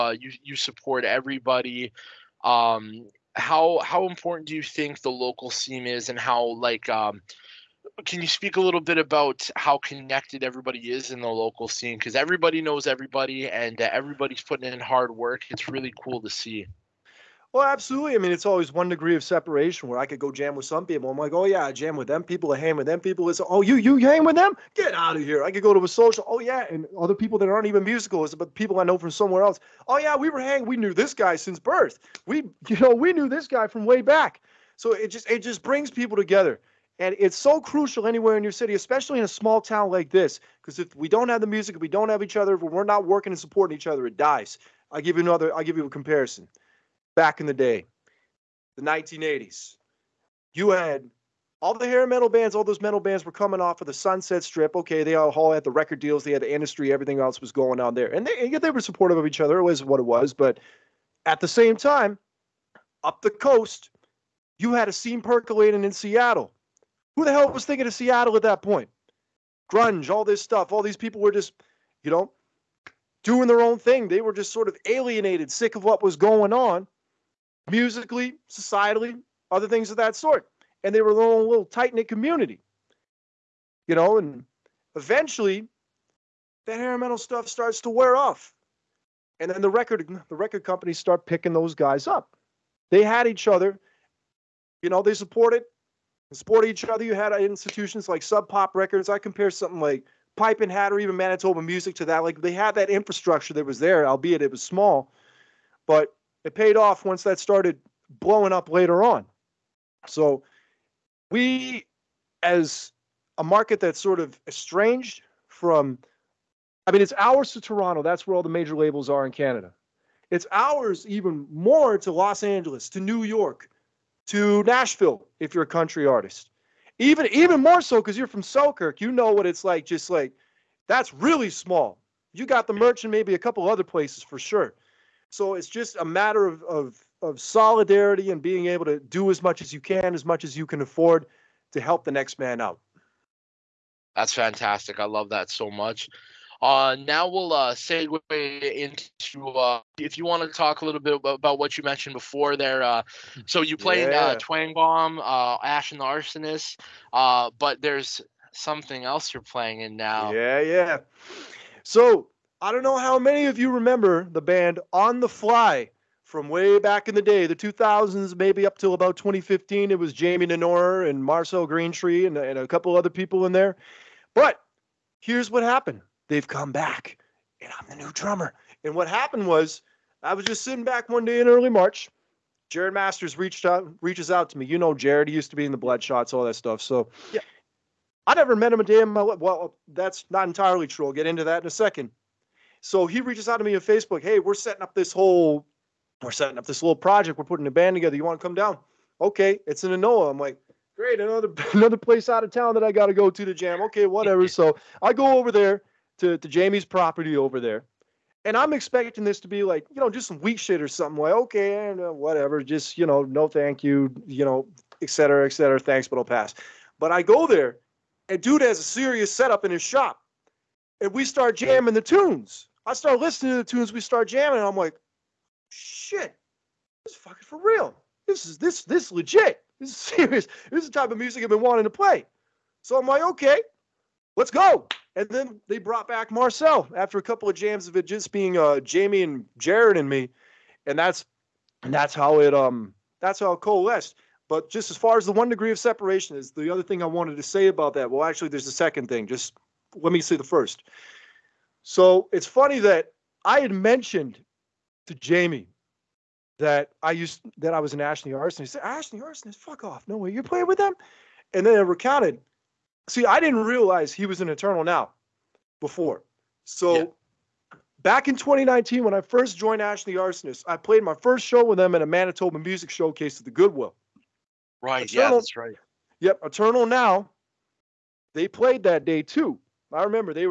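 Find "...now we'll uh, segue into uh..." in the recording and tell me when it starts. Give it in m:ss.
2:27.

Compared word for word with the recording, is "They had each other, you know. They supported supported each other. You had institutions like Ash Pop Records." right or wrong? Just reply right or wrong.
wrong.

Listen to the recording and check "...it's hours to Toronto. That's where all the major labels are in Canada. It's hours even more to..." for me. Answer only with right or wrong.
right.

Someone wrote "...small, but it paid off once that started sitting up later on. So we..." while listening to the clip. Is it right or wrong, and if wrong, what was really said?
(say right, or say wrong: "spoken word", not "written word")
wrong: "blowing", not "sitting".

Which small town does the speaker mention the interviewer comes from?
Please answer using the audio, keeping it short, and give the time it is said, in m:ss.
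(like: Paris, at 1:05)
Selkirk, at 2:08.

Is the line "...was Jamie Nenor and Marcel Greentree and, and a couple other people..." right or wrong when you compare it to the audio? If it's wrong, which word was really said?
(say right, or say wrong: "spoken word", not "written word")
right.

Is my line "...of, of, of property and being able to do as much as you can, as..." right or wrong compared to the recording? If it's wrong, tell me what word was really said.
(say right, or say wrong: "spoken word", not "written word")
wrong: "solidarity", not "property".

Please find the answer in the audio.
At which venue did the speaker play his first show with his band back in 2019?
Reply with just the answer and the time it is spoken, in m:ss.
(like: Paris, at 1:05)
the Goodwill, at 4:33.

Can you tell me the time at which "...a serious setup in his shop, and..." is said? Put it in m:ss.
3:38.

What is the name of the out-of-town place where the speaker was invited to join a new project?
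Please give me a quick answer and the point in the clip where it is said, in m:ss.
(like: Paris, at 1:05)
Anola, at 3:19.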